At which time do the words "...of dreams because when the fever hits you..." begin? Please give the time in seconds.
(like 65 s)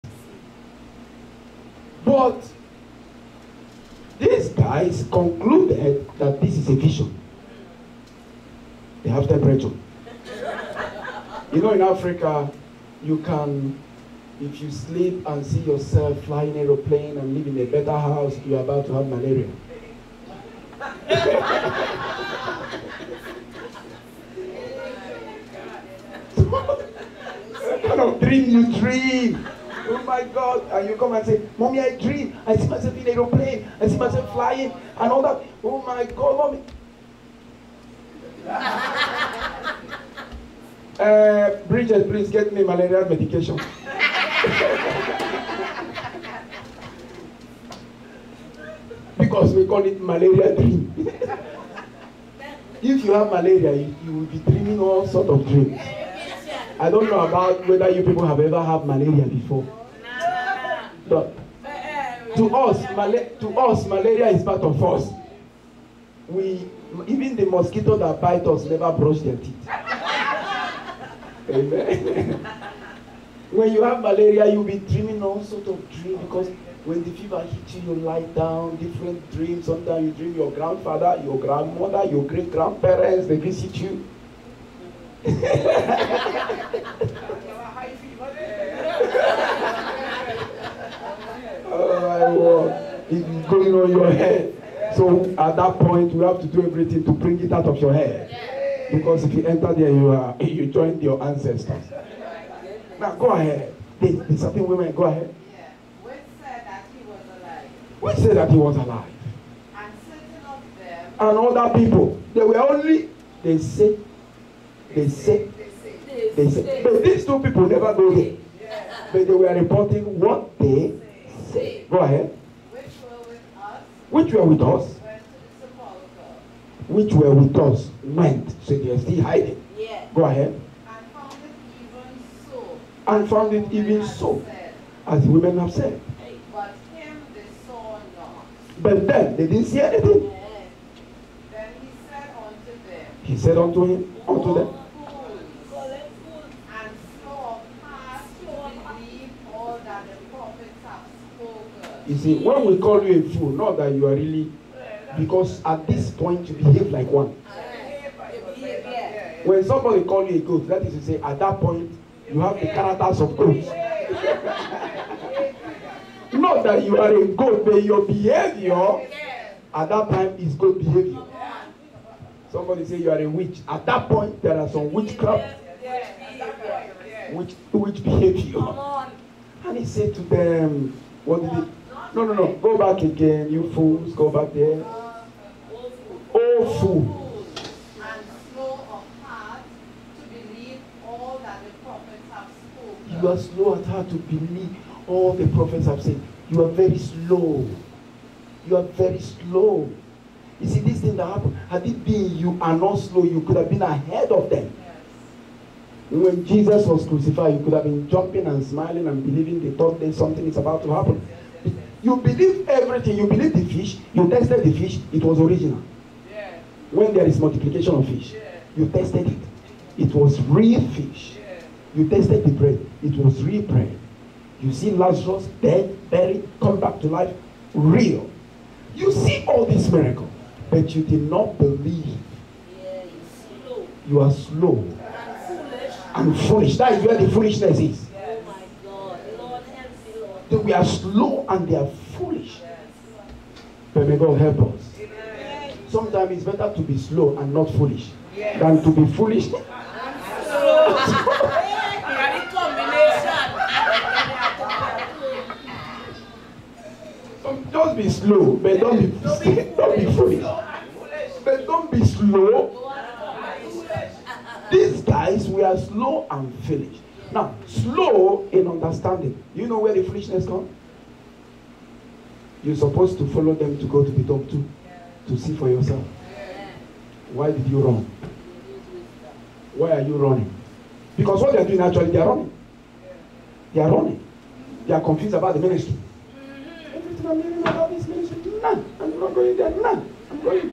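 75 s.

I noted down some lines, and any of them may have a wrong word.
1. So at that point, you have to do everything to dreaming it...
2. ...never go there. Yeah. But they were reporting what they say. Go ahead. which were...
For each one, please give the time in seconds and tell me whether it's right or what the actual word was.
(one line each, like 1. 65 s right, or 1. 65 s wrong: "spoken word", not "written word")
1. 94 s wrong: "bring", not "dreaming"
2. 117 s right.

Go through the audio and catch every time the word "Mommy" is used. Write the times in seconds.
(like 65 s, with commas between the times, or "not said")
31 s, 36 s.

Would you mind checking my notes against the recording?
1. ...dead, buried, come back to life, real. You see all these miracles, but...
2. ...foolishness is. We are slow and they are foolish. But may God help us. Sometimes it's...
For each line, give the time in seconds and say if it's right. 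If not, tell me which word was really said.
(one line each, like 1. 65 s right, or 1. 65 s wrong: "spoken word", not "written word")
1. 225 s right
2. 237 s right.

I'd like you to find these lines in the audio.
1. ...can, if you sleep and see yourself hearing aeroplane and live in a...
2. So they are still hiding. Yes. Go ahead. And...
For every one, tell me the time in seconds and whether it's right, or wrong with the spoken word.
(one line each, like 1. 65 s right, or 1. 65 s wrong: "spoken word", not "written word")
1. 13 s wrong: "flying", not "hearing"
2. 128 s right.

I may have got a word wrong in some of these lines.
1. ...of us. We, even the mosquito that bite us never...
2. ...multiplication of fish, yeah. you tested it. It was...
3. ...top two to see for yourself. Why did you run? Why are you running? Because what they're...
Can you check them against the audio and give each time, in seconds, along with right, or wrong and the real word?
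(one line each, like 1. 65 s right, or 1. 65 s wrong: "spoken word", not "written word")
1. 64 s right
2. 217 s right
3. 274 s right.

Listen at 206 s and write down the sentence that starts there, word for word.
When Jesus was crucified, you could have been jumping and smiling and believing the thought that something is about to happen.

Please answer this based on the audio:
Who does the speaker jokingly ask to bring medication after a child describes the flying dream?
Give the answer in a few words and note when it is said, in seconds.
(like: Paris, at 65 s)
Bridget, at 41 s.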